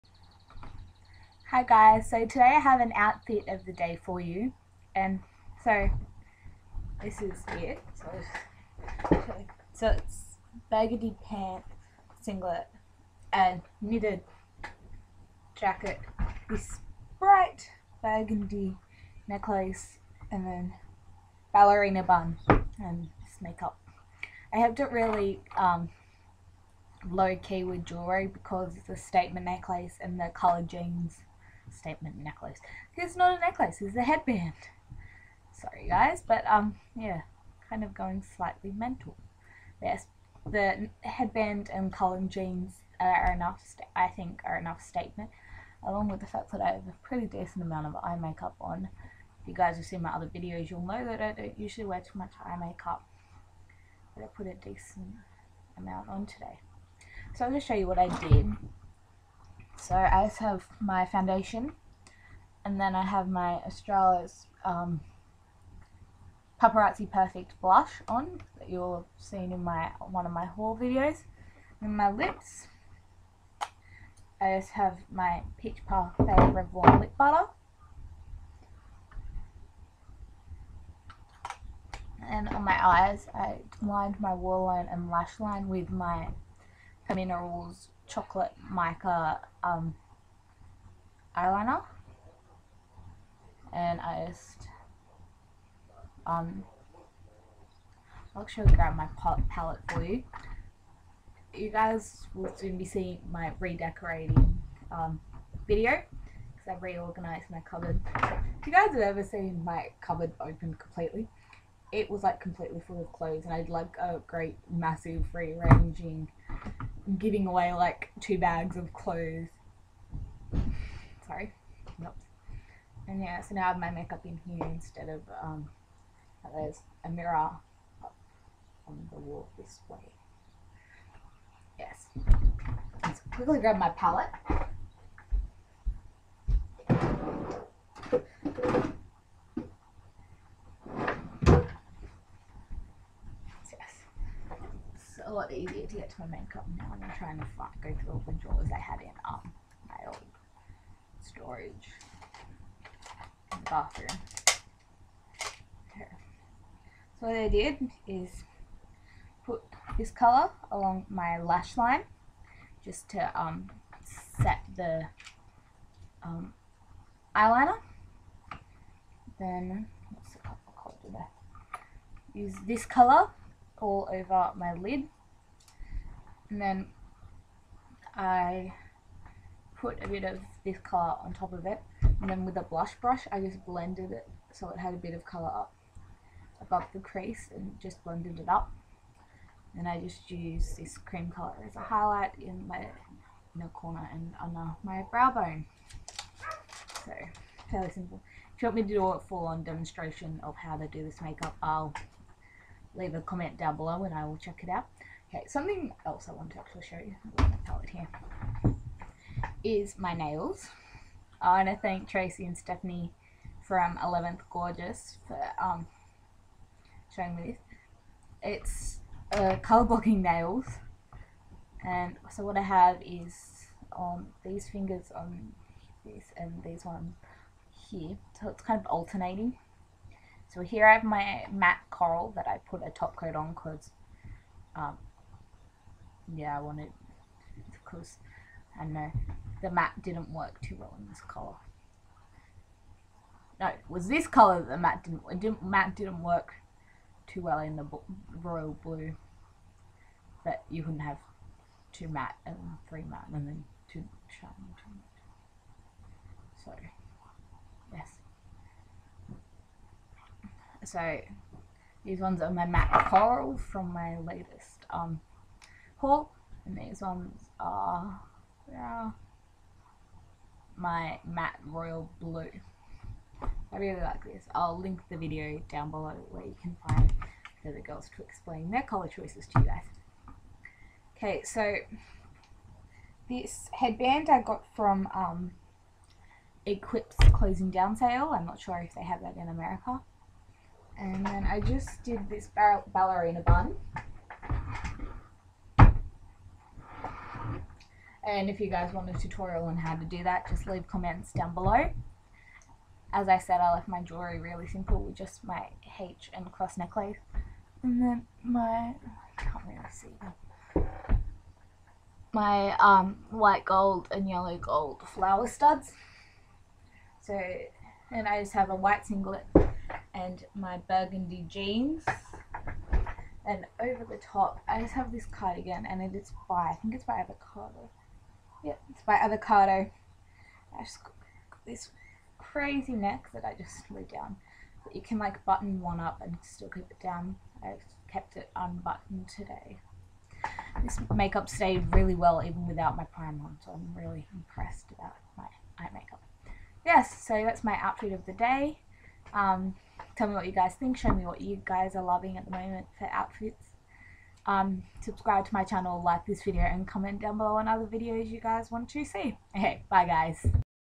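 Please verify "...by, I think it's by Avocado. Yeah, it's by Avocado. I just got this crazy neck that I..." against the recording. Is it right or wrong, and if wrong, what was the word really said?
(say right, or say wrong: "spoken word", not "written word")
right.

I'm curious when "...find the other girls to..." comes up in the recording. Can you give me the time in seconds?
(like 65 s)
276 s.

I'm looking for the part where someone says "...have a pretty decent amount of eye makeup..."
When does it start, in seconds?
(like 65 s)
46 s.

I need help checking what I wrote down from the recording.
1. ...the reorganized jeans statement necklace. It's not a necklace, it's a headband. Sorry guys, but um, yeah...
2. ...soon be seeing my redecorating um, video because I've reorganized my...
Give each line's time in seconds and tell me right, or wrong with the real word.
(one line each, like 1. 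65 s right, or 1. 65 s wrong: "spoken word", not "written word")
1. 30 s wrong: "colored", not "reorganized"
2. 102 s right.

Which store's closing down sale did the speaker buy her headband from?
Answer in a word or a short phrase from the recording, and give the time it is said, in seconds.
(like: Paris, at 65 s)
Equip, at 286 s.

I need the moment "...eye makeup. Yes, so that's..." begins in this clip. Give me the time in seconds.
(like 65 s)
345 s.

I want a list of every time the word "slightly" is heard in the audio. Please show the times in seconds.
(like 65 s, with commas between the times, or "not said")
38 s.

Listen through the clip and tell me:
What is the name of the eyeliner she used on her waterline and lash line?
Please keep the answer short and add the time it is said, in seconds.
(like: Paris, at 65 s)
Minerals Chocolate Mica, at 87 s.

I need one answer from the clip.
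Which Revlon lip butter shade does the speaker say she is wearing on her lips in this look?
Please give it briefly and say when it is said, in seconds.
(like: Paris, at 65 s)
Peach Parfait, at 75 s.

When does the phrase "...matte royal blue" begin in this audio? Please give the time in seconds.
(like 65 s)
271 s.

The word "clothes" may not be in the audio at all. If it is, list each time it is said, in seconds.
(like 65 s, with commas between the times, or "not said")
113 s, 118 s.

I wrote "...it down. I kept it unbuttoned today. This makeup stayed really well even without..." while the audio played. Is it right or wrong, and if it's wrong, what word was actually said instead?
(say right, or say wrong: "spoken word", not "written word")
right.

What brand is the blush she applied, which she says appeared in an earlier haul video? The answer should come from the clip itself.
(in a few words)
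Australis.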